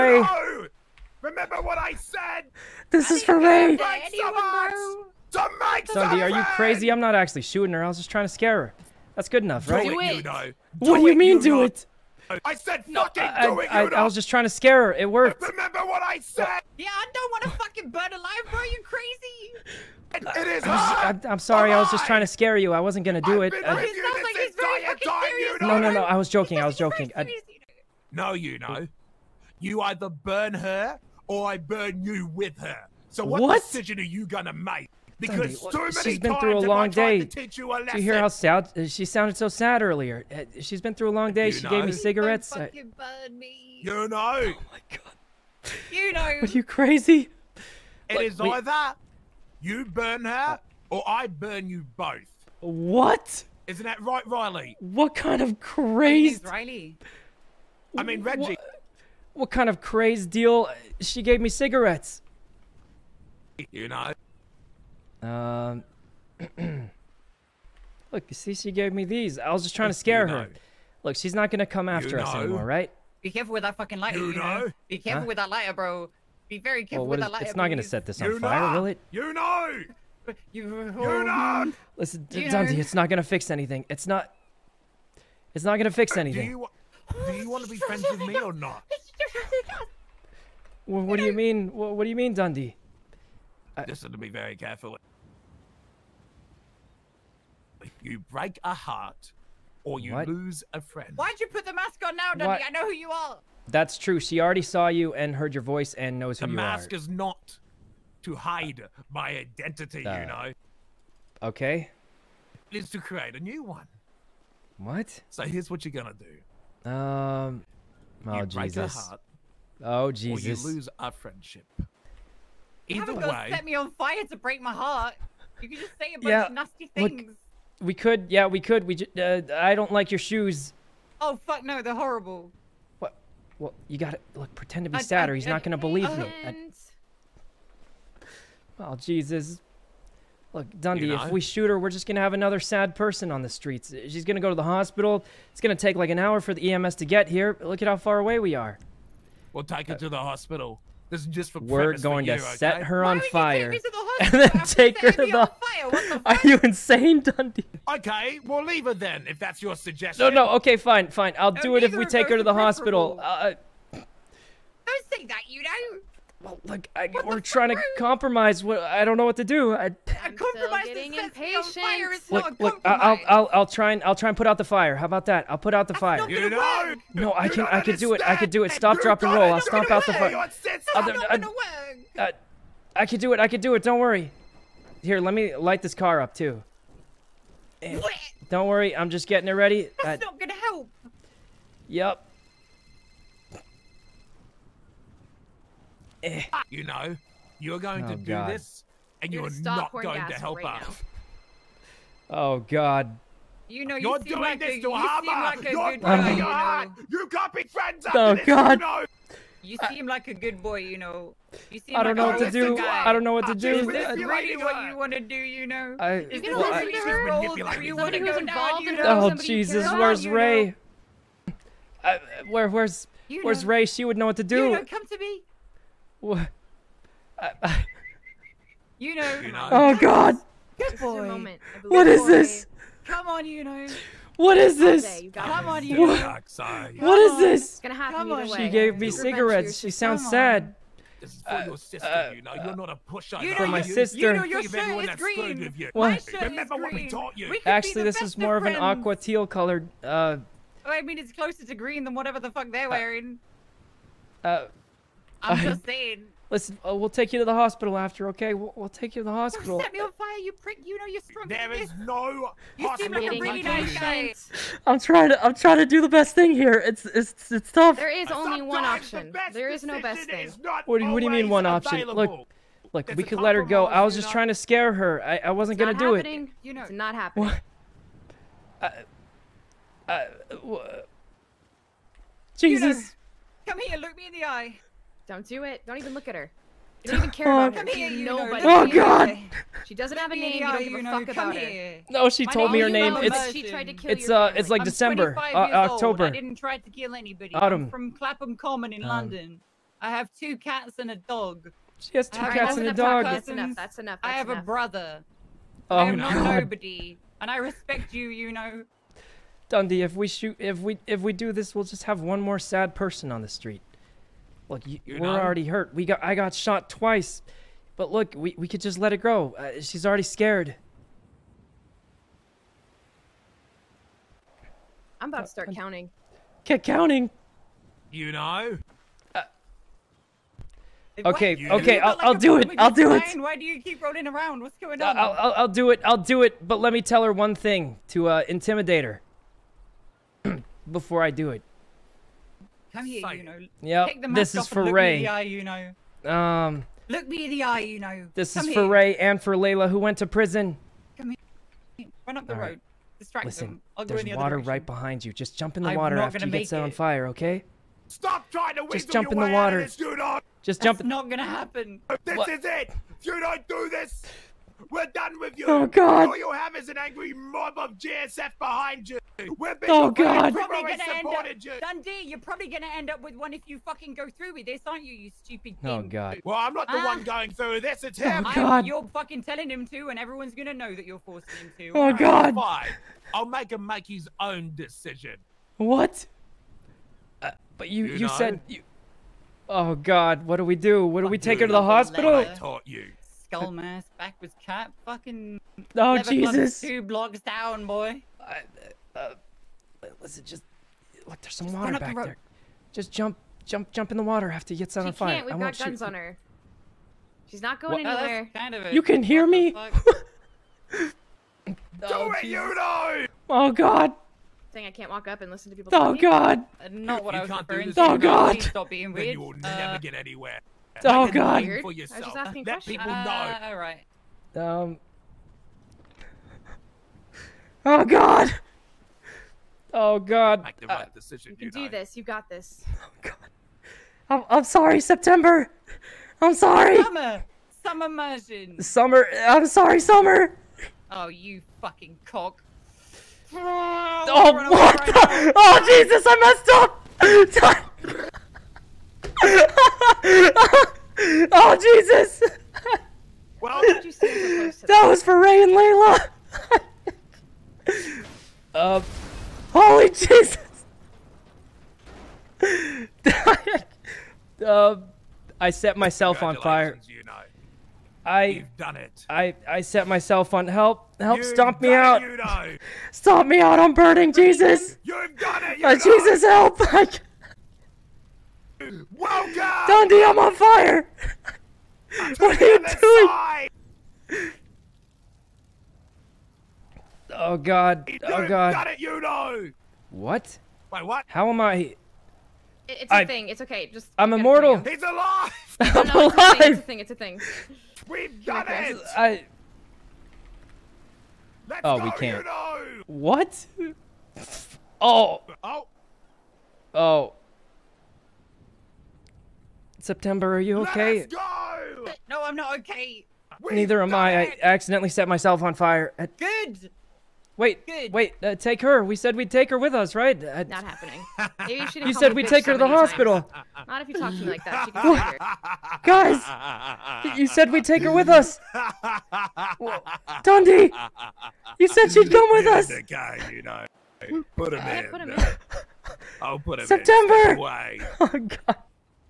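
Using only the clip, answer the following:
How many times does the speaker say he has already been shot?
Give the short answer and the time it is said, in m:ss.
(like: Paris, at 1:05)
2, at 5:16.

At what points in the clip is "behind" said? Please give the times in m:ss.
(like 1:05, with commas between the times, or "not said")
5:54, 6:08.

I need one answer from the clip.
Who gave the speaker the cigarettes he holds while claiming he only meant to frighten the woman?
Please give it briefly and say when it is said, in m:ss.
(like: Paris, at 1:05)
Cece, at 1:08.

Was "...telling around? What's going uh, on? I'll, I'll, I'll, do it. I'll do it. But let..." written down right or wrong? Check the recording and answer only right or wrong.
wrong.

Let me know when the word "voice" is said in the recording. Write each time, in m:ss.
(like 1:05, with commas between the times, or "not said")
1:45.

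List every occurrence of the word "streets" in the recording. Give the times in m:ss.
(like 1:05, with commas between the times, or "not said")
2:23, 5:13.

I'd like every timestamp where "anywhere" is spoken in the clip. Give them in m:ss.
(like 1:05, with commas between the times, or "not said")
6:48, 7:00.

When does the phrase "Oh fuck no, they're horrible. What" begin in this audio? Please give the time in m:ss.
2:11.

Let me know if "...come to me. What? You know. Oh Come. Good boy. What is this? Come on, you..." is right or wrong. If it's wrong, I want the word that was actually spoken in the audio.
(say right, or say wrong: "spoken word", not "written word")
wrong: "God", not "Come".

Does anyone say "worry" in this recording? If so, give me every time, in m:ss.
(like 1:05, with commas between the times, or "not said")
3:03, 3:08.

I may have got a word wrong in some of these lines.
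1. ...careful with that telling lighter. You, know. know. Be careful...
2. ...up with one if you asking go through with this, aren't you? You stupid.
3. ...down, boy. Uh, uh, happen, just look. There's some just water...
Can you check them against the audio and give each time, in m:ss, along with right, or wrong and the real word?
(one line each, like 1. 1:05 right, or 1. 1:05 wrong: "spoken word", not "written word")
1. 1:13 wrong: "fucking", not "telling"
2. 6:13 wrong: "fucking", not "asking"
3. 6:37 wrong: "listen", not "happen".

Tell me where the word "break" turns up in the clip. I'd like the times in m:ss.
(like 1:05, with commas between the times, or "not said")
1:38, 2:04.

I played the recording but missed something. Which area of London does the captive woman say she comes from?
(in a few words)
Clapham Common.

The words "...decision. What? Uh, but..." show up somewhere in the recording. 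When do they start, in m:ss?
6:24.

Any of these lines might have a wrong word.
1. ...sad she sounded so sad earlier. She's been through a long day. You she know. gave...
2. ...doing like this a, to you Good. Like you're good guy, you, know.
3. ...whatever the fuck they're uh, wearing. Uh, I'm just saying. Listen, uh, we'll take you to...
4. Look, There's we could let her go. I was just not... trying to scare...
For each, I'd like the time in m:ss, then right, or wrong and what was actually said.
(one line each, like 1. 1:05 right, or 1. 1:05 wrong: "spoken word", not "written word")
1. 0:38 right
2. 3:24 wrong: "Hama", not "Good"
3. 4:12 right
4. 4:32 right.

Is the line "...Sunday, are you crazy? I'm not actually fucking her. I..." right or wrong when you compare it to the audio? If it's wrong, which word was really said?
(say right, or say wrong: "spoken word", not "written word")
wrong: "shooting", not "fucking".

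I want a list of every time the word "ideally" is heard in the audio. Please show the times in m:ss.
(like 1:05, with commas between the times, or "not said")
not said.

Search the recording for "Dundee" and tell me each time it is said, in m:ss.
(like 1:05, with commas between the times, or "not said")
1:22, 1:32, 2:20, 2:37, 5:09, 6:11, 7:59, 8:50.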